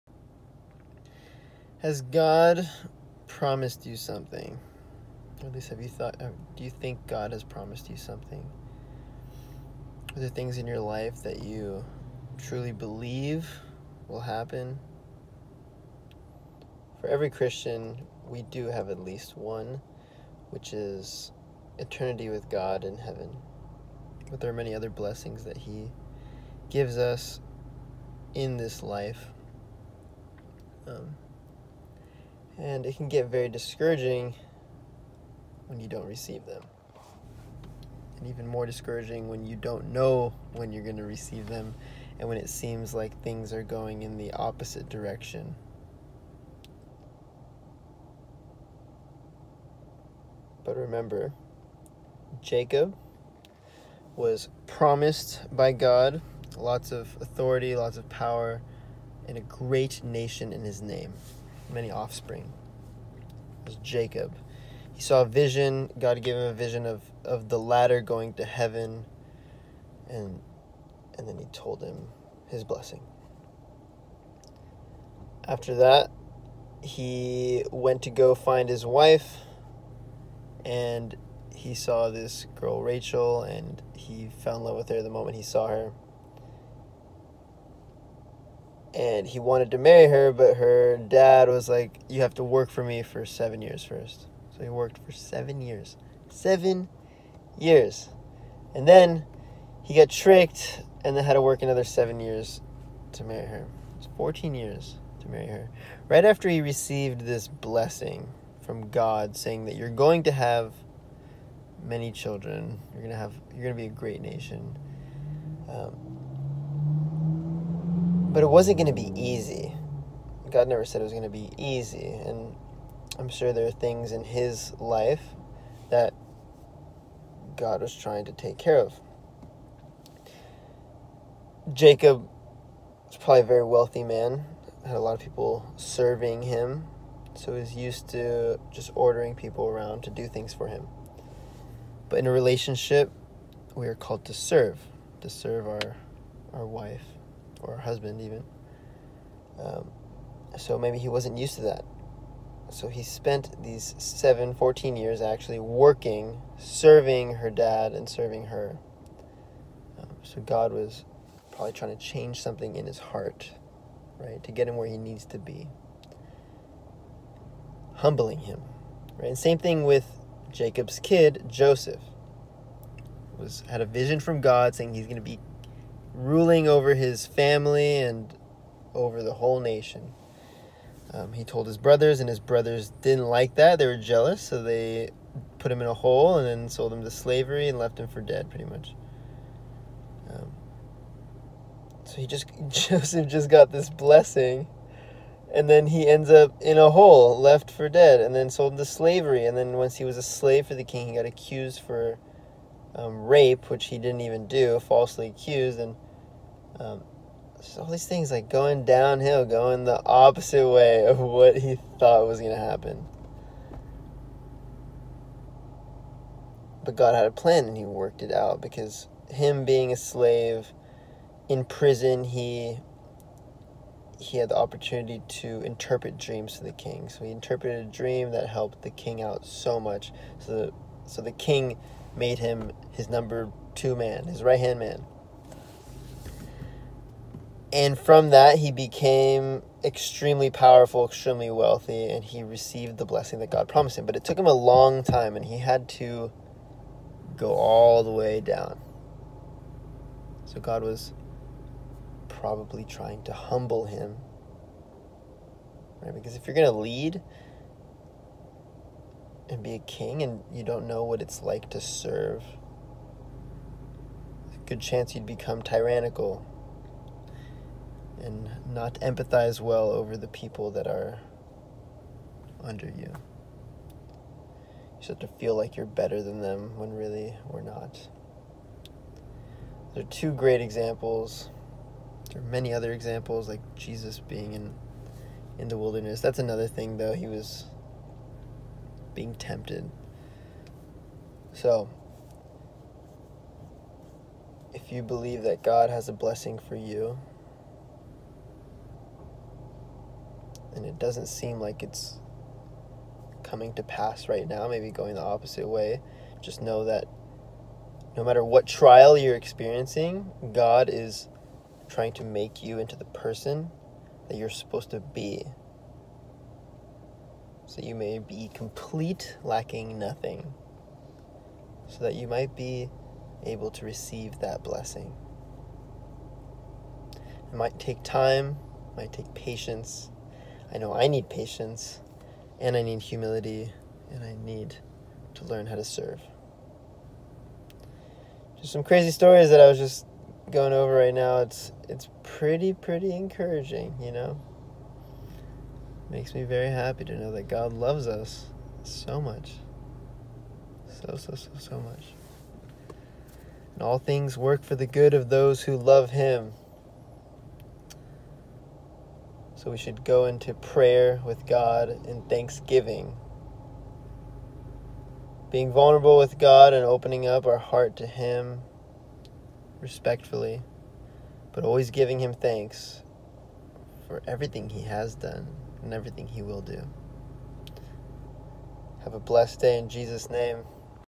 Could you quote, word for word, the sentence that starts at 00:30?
Um, and it can get very discouraging when you don't receive them.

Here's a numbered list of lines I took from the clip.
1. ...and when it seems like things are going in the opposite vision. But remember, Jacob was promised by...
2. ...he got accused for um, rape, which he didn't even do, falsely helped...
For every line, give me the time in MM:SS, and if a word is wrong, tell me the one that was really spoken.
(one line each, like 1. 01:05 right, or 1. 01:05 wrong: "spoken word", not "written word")
1. 00:42 wrong: "direction", not "vision"
2. 03:21 wrong: "accused", not "helped".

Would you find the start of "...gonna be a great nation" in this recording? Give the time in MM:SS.
01:53.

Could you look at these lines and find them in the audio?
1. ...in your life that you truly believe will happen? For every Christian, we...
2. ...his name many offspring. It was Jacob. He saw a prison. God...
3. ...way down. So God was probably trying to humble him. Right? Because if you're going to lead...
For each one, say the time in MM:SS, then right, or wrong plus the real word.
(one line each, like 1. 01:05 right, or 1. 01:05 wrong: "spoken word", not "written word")
1. 00:10 right
2. 01:00 wrong: "vision", not "prison"
3. 04:08 right.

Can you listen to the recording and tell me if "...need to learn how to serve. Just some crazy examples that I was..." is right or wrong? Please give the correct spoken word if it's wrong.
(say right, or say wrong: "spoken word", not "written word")
wrong: "stories", not "examples".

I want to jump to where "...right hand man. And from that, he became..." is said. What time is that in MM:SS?
03:54.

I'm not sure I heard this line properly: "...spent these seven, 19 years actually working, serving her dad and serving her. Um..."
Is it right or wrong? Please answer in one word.
wrong.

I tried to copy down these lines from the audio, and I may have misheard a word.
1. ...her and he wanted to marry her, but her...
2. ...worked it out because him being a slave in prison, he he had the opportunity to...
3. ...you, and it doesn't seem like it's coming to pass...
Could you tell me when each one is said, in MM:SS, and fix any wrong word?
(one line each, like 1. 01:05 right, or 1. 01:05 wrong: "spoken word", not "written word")
1. 01:25 right
2. 03:37 right
3. 04:56 right.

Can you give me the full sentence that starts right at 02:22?
But in a relationship, we are called to serve, to serve our, our wife, or husband even.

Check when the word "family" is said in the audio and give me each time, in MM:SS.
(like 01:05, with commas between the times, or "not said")
02:57.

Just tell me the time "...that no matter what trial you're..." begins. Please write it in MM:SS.
05:06.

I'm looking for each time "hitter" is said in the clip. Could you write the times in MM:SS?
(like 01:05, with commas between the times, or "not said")
not said.